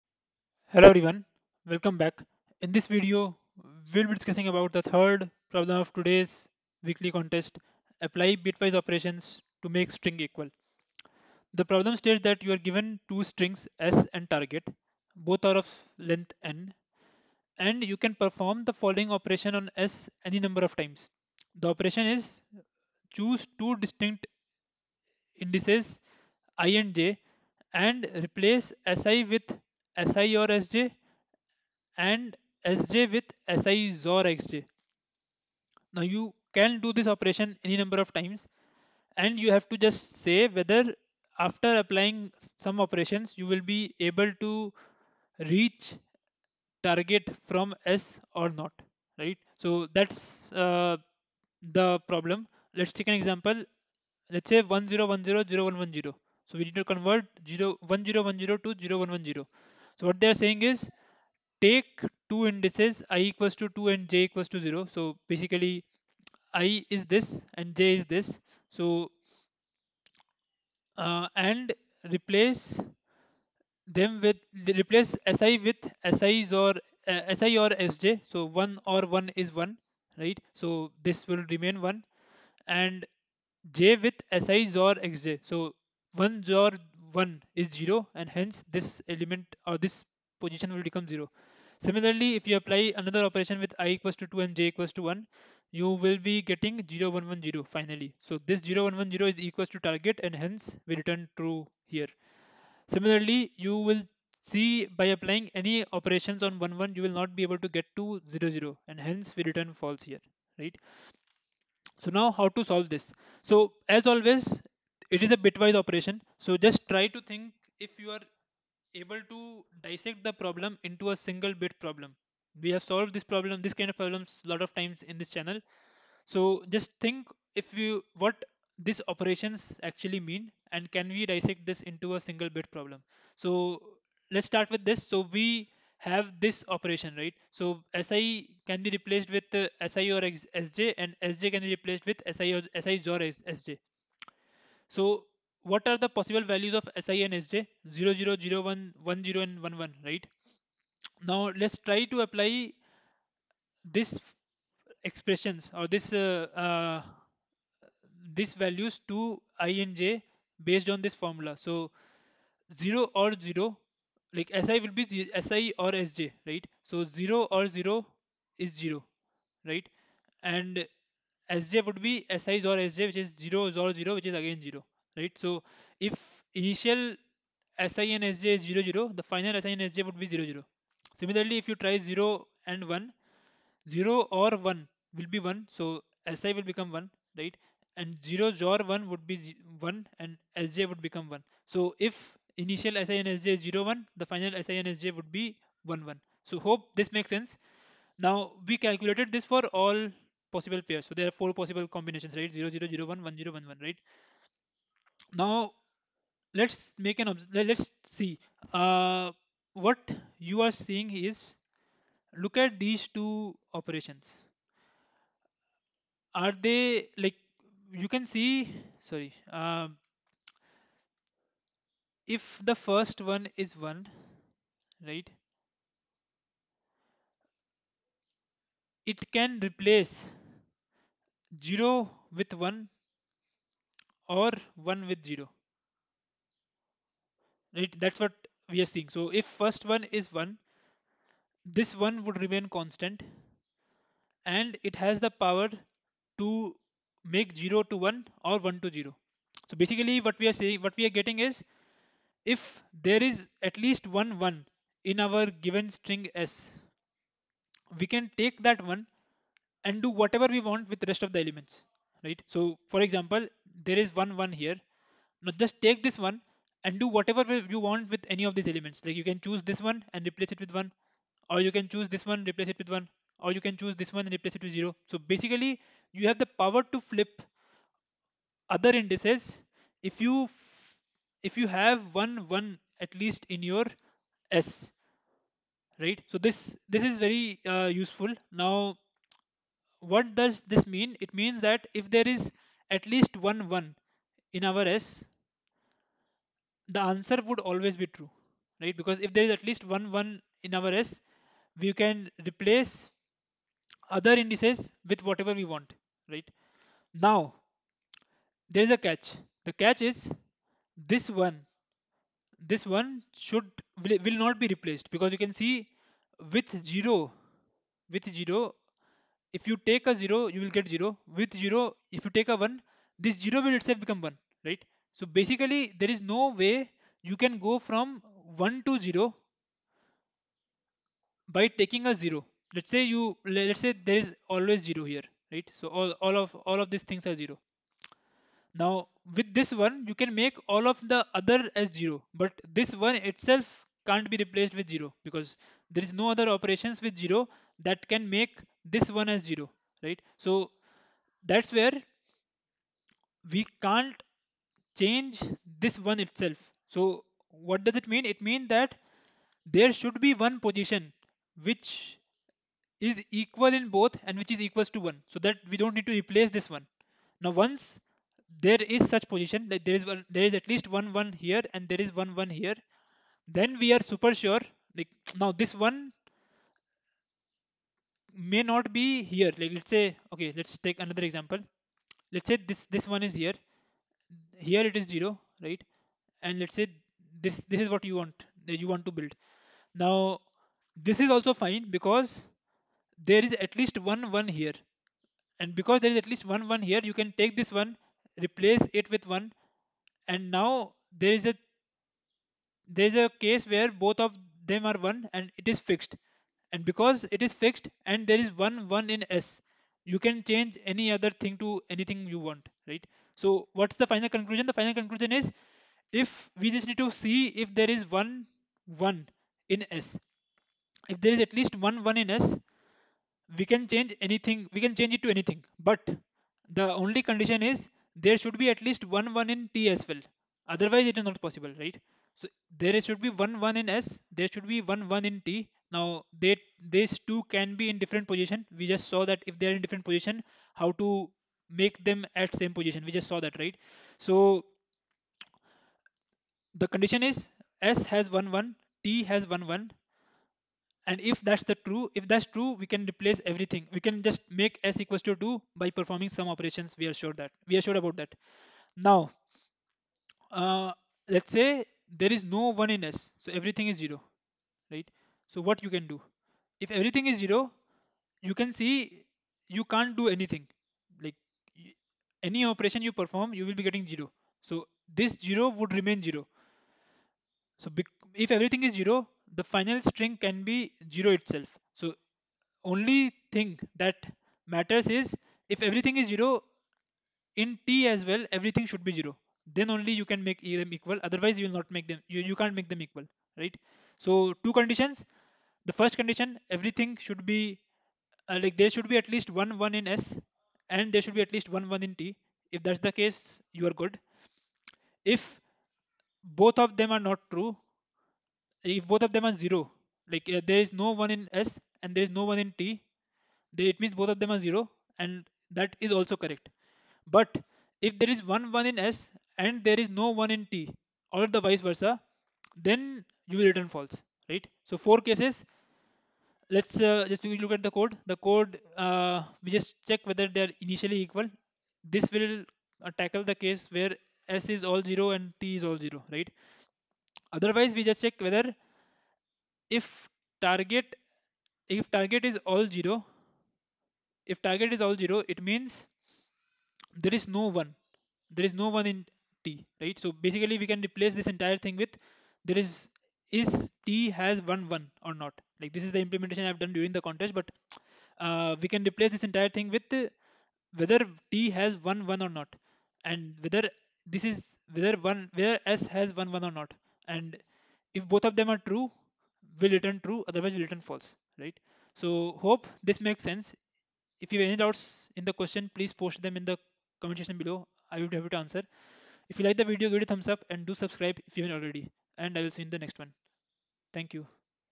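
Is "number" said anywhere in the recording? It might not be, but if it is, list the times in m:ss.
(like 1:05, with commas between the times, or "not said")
0:20, 0:37.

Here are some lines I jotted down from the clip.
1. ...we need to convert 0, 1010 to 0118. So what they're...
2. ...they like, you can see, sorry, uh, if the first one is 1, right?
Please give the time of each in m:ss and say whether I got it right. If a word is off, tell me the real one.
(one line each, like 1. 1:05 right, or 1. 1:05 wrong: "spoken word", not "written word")
1. 0:56 wrong: "0110", not "0118"
2. 3:36 right.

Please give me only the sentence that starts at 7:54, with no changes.
So this zero would remain zero.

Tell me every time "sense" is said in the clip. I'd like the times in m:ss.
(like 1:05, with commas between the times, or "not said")
3:17, 9:33.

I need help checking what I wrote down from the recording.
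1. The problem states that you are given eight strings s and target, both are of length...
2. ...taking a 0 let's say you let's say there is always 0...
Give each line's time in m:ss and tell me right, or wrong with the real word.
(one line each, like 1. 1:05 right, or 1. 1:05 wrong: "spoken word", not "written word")
1. 0:11 wrong: "two", not "eight"
2. 5:31 right.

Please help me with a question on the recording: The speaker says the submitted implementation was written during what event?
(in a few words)
the contest.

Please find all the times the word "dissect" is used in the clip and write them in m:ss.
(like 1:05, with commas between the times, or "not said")
1:59, 2:11.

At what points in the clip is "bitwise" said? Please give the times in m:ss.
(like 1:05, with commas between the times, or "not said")
0:08, 1:55.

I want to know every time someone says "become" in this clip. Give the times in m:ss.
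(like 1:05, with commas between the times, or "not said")
1:30, 3:06, 3:11, 5:24.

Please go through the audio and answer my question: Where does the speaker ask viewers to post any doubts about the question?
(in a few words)
comment section.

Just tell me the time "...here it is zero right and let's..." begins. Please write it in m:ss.
6:24.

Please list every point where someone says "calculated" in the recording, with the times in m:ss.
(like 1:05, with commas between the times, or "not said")
3:18.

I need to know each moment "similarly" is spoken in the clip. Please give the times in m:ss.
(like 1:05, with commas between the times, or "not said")
1:31, 1:42, 3:01.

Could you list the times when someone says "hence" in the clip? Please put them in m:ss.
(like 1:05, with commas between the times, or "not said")
1:28, 1:40, 1:48.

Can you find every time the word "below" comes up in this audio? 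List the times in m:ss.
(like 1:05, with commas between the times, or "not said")
9:37.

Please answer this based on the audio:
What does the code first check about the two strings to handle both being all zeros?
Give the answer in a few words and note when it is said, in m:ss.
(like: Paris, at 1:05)
whether they're initially equal, at 8:50.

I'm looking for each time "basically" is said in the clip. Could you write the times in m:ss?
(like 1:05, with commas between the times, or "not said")
1:05, 4:09, 4:35, 5:25, 9:10.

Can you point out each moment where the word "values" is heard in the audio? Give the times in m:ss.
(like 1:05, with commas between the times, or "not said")
2:26, 2:38.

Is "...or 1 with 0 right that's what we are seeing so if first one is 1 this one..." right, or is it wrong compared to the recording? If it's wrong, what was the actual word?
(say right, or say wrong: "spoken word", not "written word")
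right.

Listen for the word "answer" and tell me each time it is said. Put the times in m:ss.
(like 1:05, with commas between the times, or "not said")
4:56, 9:38.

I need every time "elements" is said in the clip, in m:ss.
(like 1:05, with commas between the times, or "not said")
1:29, 4:21, 4:28.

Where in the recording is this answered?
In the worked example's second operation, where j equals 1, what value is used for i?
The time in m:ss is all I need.
1:33.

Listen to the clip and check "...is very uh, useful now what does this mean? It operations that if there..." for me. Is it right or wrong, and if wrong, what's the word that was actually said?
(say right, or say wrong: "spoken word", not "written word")
wrong: "means", not "operations".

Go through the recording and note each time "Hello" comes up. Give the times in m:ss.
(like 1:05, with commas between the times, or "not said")
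0:00.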